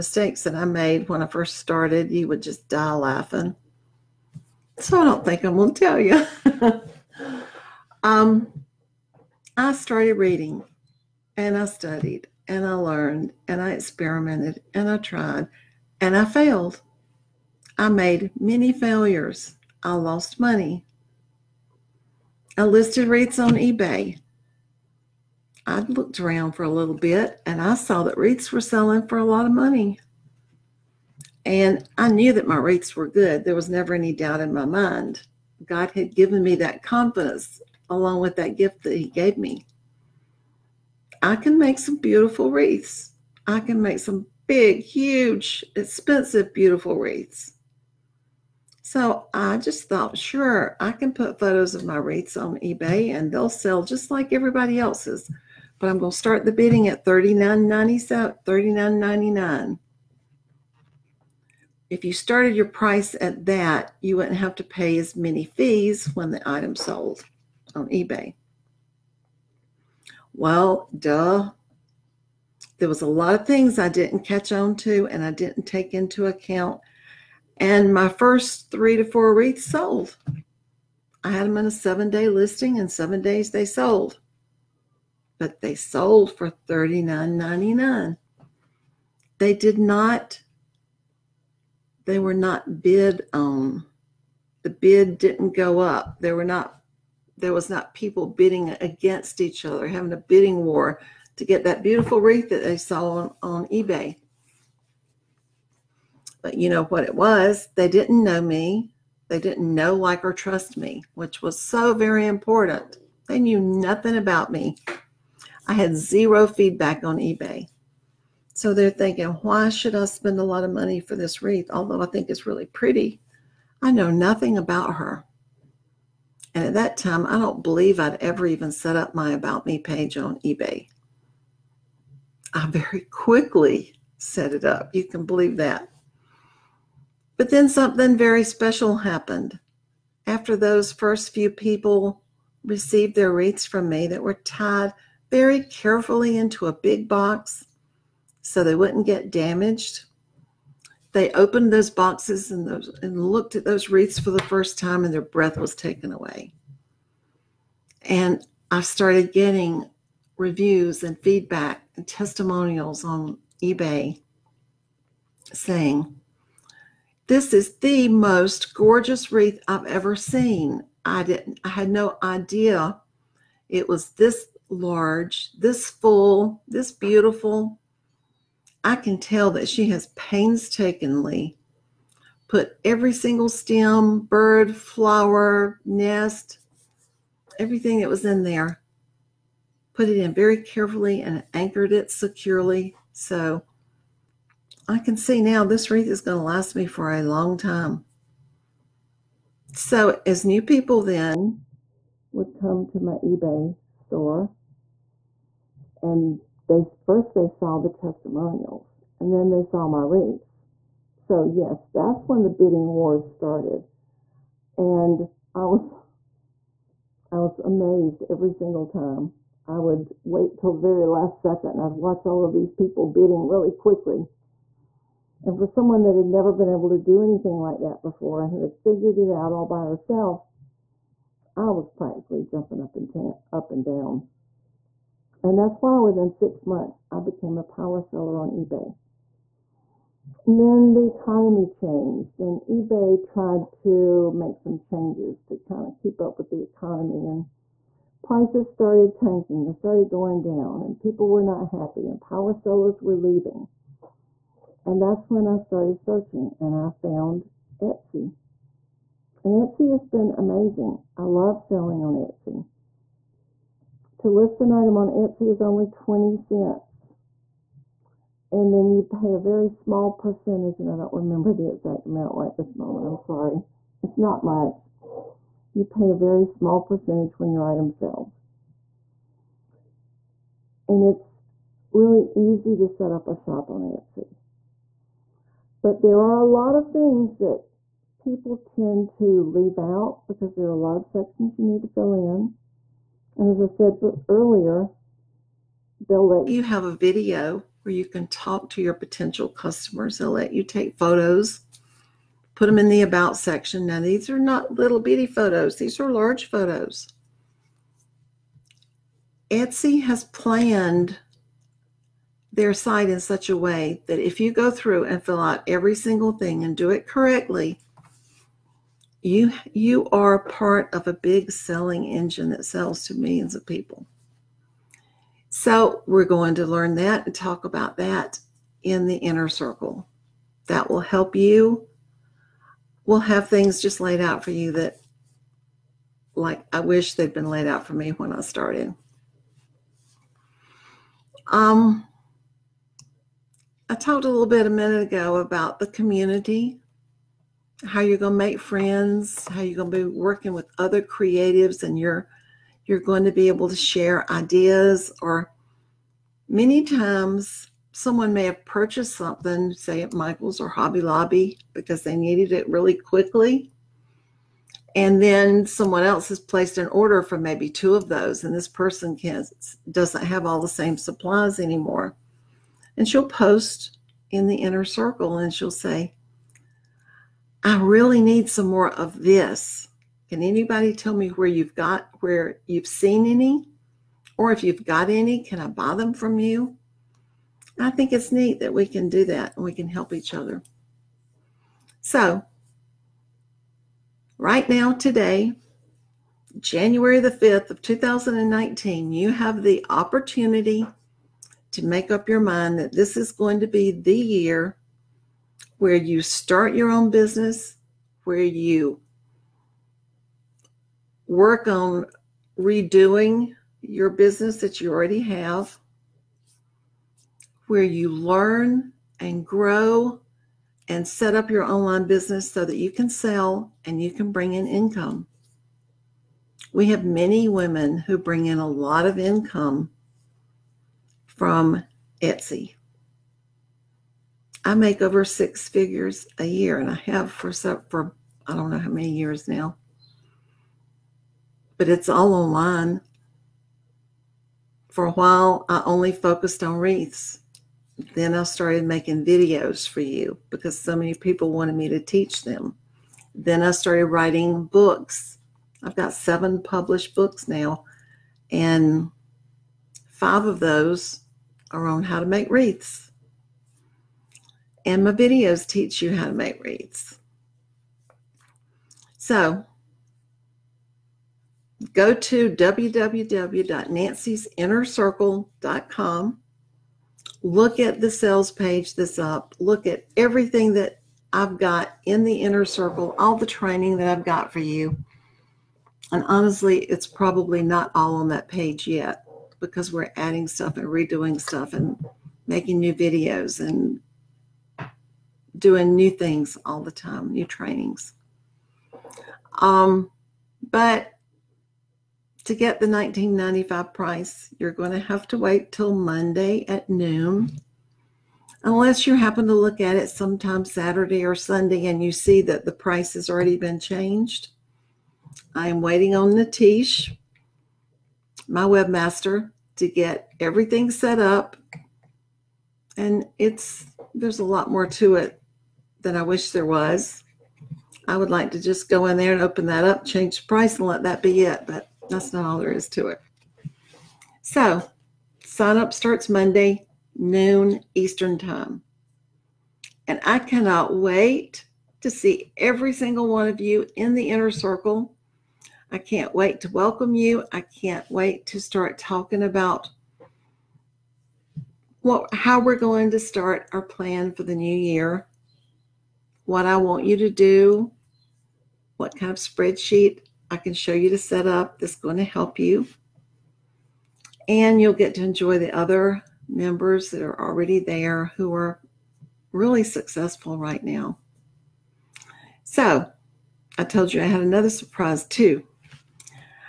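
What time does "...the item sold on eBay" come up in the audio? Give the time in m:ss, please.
1:06.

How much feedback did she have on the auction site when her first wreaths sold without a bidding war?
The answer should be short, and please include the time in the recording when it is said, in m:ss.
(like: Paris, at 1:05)
zero, at 1:55.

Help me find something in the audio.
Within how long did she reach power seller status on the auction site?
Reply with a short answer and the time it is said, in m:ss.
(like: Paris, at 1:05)
six months, at 3:56.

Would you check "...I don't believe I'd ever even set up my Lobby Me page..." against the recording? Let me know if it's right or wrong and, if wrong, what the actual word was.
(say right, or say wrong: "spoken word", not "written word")
wrong: "About", not "Lobby".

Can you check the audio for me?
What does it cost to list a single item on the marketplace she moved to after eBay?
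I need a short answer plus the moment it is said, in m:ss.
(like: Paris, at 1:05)
20 cents, at 4:25.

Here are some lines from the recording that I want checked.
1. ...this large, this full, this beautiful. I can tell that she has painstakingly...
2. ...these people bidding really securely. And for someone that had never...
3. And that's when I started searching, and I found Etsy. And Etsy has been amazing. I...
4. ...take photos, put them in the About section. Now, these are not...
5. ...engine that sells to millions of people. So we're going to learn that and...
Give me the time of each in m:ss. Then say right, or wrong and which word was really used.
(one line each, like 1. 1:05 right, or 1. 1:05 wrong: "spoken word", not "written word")
1. 2:54 right
2. 3:42 wrong: "quickly", not "securely"
3. 4:14 right
4. 5:00 right
5. 5:22 right.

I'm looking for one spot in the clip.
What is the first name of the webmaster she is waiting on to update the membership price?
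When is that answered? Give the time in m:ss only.
8:36.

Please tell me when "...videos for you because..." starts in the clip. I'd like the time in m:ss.
7:29.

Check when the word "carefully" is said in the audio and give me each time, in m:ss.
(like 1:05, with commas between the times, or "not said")
2:25, 3:10.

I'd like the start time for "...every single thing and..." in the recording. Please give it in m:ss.
5:15.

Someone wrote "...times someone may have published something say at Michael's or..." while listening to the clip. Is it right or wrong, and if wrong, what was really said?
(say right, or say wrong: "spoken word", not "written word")
wrong: "purchased", not "published".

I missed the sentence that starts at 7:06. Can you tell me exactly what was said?
We have many women who bring in a lot of income from Etsy.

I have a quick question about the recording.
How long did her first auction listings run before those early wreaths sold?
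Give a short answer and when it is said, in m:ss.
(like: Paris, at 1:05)
seven days, at 1:21.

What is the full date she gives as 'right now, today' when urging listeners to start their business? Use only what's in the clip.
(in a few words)
January 5, 2019.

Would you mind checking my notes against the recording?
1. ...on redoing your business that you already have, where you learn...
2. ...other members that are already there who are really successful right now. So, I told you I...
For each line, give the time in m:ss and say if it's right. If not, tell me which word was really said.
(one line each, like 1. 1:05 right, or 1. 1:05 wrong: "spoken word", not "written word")
1. 6:51 right
2. 9:25 right.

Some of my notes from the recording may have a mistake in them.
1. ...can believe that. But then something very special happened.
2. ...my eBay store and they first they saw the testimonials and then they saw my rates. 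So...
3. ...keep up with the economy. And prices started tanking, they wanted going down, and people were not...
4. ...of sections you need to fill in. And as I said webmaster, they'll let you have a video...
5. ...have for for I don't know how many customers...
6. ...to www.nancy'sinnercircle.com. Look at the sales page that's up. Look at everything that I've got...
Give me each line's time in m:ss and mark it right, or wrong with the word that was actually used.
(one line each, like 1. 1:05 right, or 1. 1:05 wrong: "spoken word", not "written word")
1. 2:15 right
2. 3:23 right
3. 4:05 wrong: "started", not "wanted"
4. 4:50 wrong: "earlier", not "webmaster"
5. 7:17 wrong: "years", not "customers"
6. 7:52 right.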